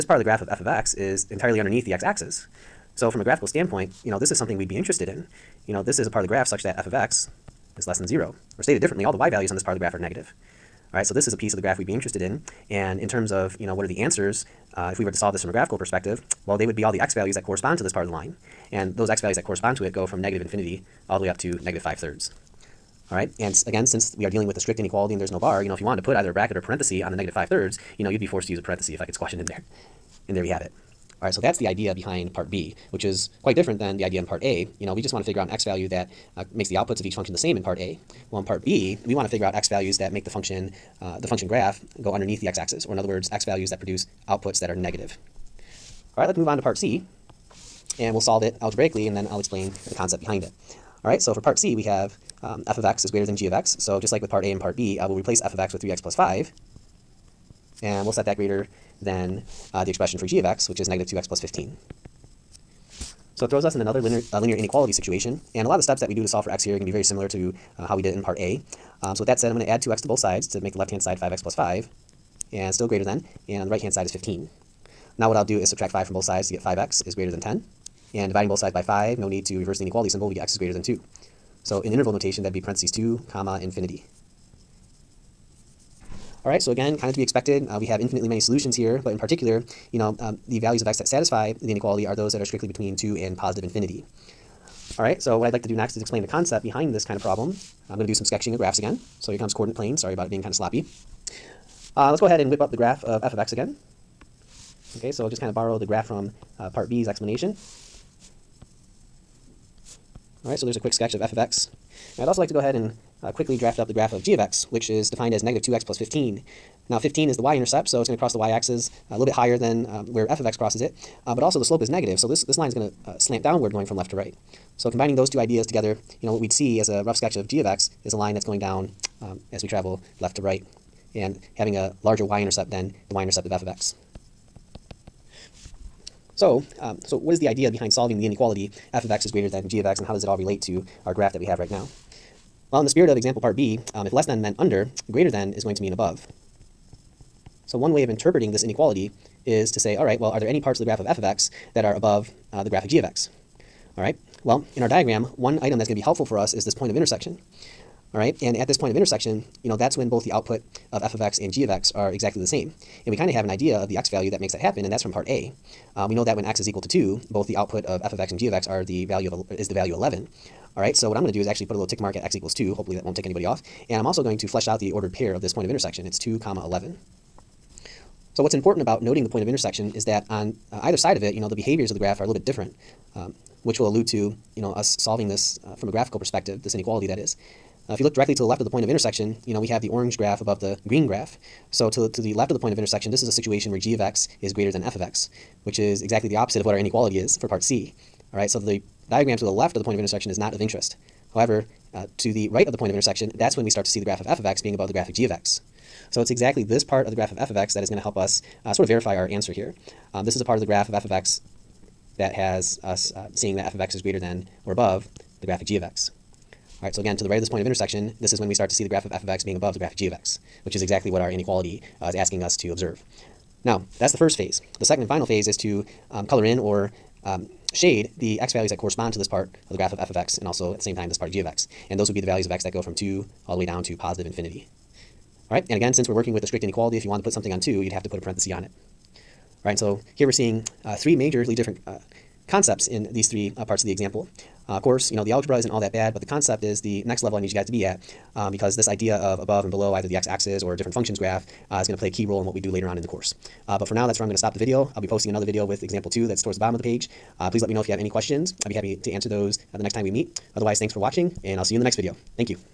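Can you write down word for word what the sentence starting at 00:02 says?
So from a graphical standpoint, you know, this is something we'd be interested in.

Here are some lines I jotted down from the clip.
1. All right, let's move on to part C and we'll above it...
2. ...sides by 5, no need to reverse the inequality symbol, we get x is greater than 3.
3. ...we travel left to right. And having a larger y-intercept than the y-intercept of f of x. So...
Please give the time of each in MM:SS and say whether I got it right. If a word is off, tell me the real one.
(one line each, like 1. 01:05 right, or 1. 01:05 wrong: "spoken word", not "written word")
1. 00:46 wrong: "solve", not "above"
2. 01:18 wrong: "2", not "3"
3. 02:09 right.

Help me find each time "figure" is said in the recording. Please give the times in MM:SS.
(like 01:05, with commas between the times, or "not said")
00:35, 00:39.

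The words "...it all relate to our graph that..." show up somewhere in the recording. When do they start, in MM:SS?
02:20.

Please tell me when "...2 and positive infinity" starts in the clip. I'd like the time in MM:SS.
01:32.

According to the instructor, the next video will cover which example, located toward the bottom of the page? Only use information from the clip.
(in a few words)
Example 2.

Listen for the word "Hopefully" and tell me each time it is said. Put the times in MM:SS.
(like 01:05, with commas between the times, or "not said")
02:52.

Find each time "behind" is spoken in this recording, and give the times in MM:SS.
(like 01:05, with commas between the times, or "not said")
00:31, 00:50, 01:36, 02:17.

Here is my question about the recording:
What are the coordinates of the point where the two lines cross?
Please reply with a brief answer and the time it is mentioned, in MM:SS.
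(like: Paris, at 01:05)
(2, 11), at 02:56.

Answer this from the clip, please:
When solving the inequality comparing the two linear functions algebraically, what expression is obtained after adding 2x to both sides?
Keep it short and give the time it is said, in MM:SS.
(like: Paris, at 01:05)
5x + 5, at 01:11.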